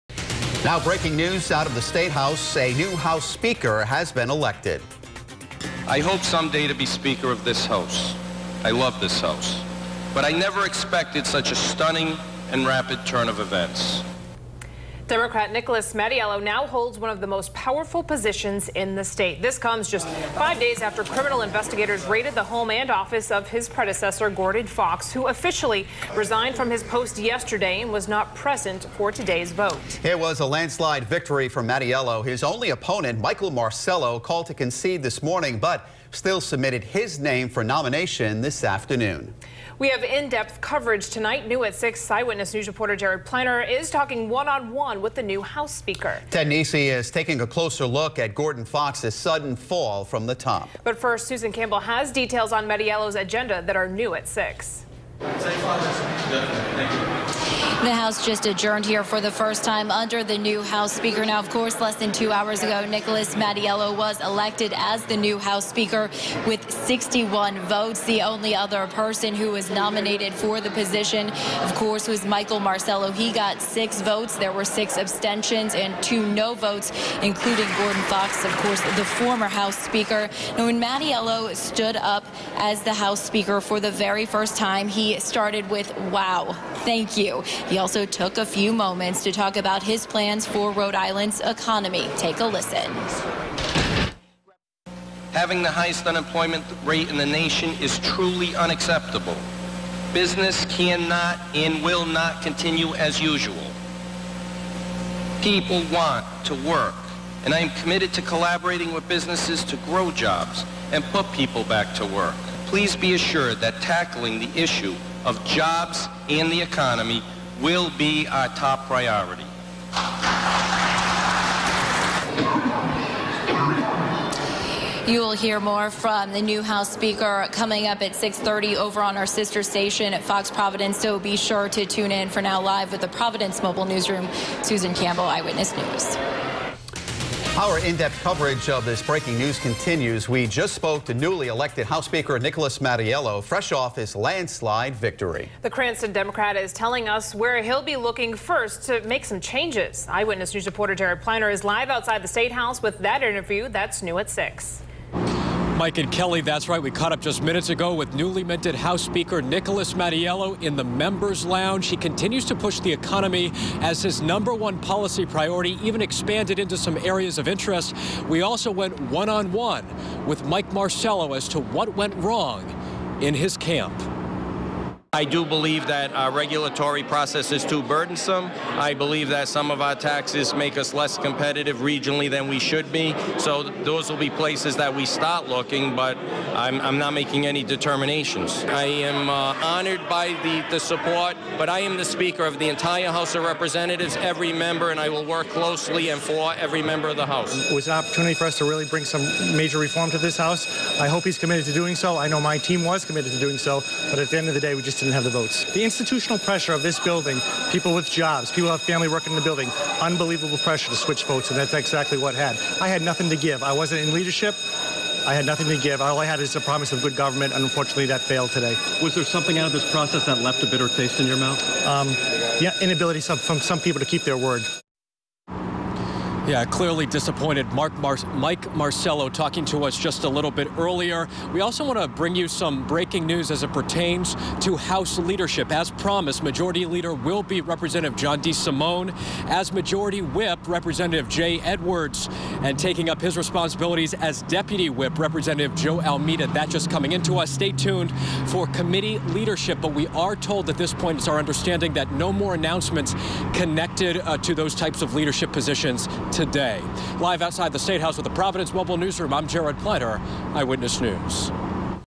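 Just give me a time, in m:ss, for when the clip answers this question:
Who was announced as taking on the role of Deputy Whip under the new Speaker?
4:05.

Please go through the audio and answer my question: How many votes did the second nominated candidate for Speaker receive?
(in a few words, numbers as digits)
6.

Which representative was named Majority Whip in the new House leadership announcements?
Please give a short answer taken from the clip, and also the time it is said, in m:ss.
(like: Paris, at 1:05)
Jay Edwards, at 4:01.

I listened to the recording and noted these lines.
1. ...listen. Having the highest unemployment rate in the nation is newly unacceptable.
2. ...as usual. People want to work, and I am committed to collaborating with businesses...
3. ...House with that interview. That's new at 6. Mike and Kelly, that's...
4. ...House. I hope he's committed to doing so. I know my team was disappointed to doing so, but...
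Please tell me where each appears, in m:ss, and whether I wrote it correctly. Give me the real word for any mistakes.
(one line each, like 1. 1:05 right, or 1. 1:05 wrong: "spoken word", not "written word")
1. 1:32 wrong: "truly", not "newly"
2. 1:42 right
3. 2:32 right
4. 3:20 wrong: "committed", not "disappointed".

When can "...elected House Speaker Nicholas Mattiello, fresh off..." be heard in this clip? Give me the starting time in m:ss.
2:21.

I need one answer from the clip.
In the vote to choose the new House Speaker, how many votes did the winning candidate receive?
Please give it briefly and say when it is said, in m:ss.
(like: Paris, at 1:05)
61, at 1:06.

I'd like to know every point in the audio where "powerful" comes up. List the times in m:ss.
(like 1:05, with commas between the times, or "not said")
0:17.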